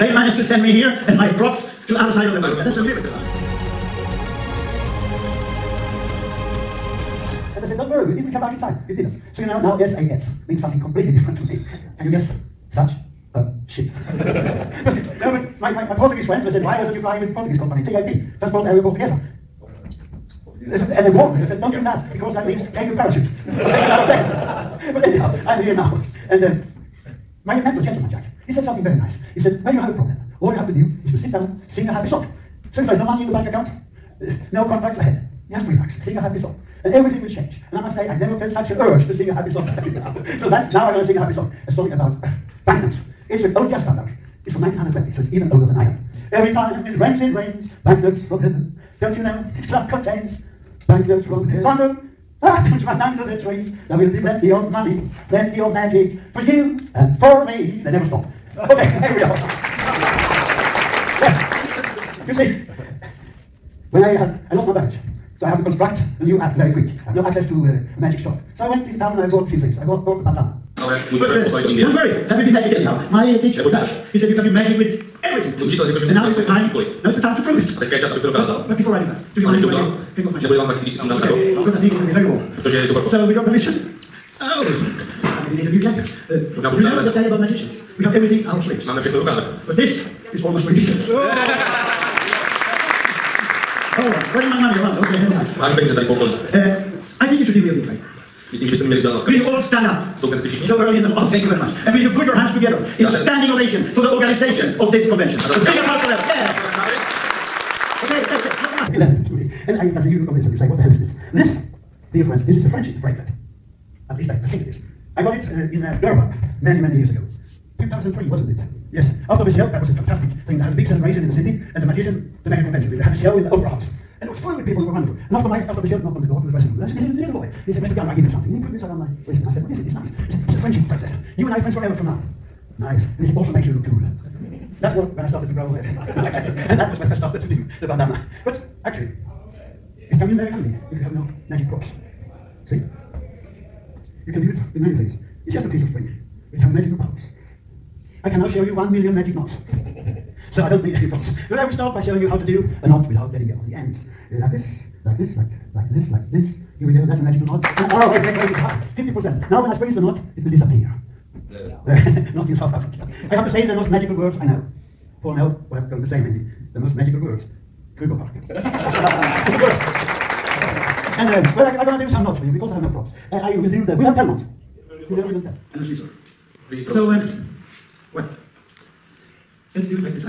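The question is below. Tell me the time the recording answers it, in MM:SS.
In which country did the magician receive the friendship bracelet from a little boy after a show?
01:56.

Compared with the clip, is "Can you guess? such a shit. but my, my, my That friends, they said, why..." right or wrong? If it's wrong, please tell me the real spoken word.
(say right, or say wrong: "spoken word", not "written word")
wrong: "Portuguese", not "That".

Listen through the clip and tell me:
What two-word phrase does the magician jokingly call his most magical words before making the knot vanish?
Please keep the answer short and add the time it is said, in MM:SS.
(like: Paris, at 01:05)
Kruger Park, at 02:47.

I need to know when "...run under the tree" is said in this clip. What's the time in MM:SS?
00:52.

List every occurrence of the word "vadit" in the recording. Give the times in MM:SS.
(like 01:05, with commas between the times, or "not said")
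01:20.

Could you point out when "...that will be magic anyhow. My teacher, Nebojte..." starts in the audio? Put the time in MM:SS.
01:12.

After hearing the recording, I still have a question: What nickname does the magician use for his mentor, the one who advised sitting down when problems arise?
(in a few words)
Gentleman Jack.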